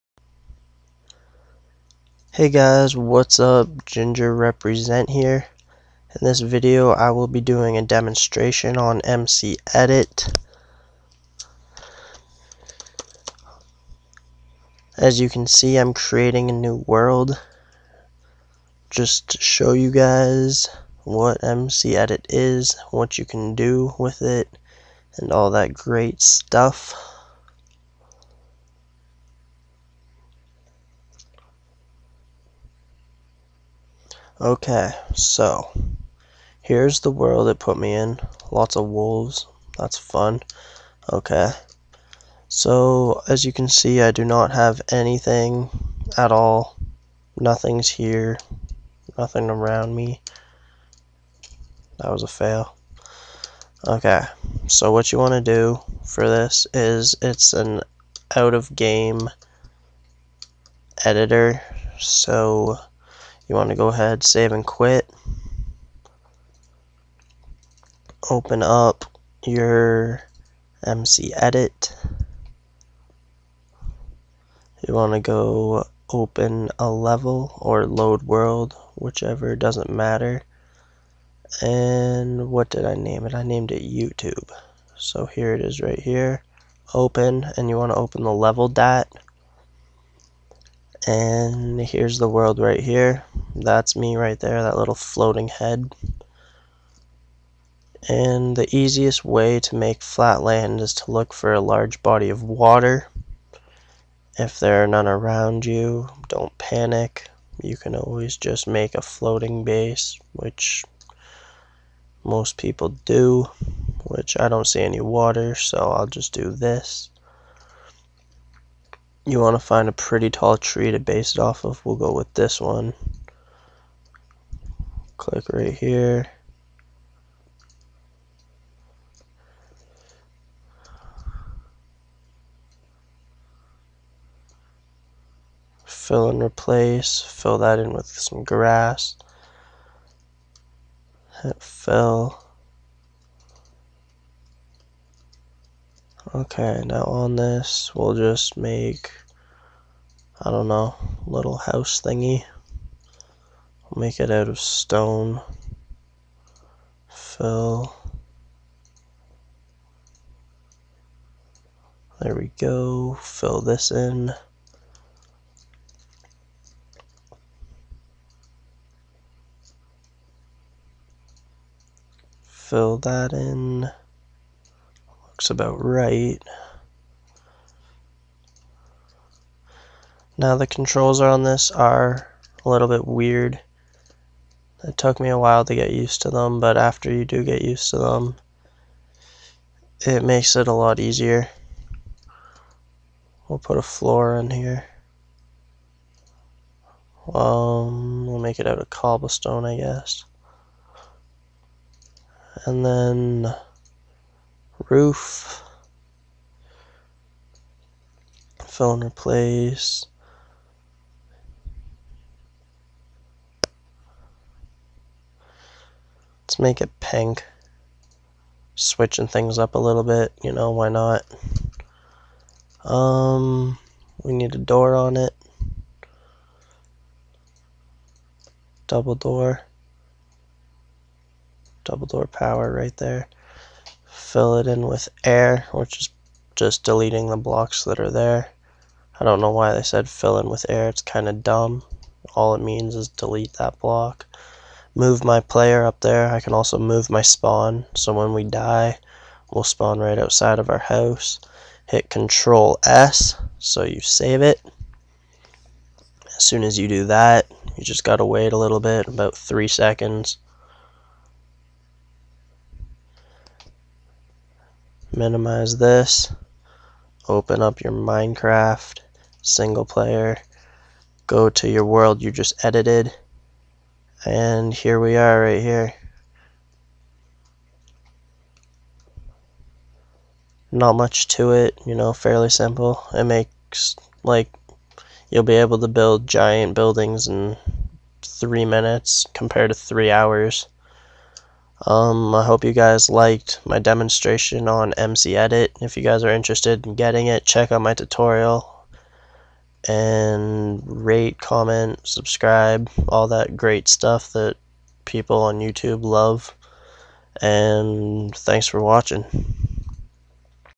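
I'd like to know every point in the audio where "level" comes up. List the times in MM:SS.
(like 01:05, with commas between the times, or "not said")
01:16, 01:28.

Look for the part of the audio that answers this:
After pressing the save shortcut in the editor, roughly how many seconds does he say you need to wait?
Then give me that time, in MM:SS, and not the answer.
04:19.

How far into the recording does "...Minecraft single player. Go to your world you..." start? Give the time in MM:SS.
04:27.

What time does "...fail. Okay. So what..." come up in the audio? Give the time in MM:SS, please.
00:52.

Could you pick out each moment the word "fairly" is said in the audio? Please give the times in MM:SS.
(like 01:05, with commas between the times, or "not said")
04:42.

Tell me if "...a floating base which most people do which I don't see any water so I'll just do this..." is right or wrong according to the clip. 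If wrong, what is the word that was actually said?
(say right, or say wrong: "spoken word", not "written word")
right.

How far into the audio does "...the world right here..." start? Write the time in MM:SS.
01:32.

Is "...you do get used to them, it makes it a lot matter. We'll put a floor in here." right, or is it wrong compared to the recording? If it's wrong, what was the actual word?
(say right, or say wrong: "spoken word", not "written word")
wrong: "easier", not "matter".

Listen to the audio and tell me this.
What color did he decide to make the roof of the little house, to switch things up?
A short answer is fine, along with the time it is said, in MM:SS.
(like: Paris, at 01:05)
pink, at 03:36.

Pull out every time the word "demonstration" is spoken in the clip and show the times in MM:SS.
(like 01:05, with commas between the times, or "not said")
00:07, 04:53.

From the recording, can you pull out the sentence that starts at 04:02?
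All it means is delete that block move my player up there.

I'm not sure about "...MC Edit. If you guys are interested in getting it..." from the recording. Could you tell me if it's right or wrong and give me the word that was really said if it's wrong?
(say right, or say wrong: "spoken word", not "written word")
right.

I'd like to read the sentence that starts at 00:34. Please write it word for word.
Okay, so here's the world it put me in.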